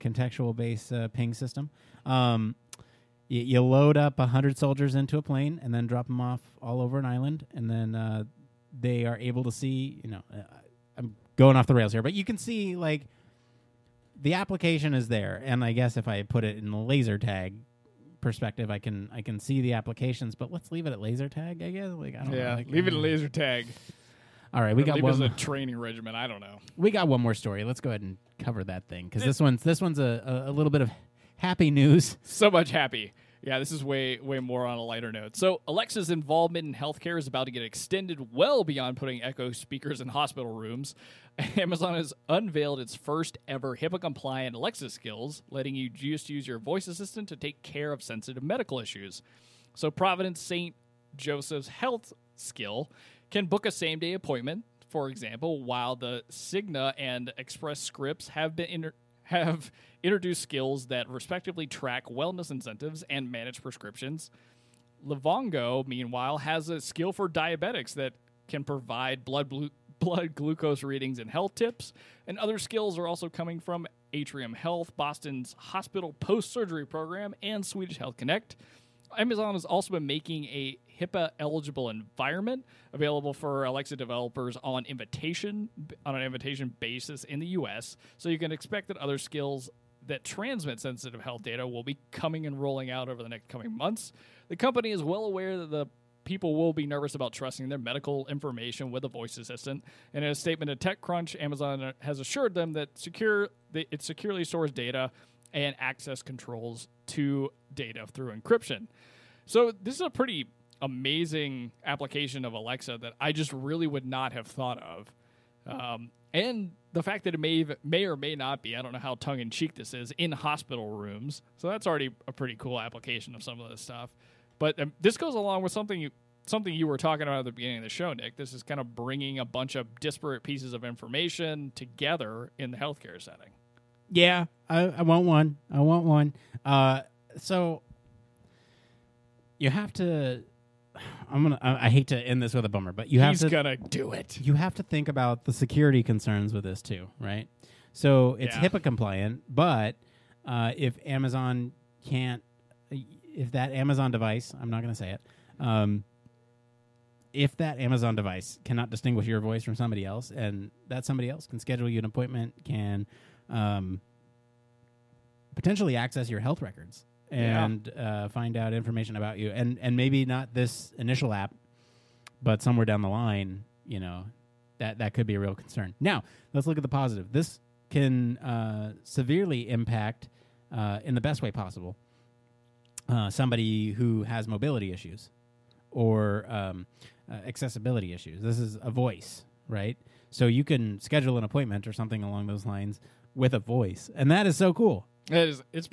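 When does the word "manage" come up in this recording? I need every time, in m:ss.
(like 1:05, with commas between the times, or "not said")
1:03.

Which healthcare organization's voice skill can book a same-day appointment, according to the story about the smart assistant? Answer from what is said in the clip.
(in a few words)
Providence St. Joseph.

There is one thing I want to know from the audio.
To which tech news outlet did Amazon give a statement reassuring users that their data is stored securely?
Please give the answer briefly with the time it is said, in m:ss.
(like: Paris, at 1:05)
TechCrunch, at 1:40.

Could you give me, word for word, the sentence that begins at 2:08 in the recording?
This is kind of bringing a bunch of disparate pieces of information together in the healthcare setting.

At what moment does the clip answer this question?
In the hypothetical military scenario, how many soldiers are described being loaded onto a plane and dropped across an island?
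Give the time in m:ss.
0:04.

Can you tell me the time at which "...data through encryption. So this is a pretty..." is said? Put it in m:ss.
1:47.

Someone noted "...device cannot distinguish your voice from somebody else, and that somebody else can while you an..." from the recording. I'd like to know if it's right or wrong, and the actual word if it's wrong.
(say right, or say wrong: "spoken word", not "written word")
wrong: "schedule", not "while".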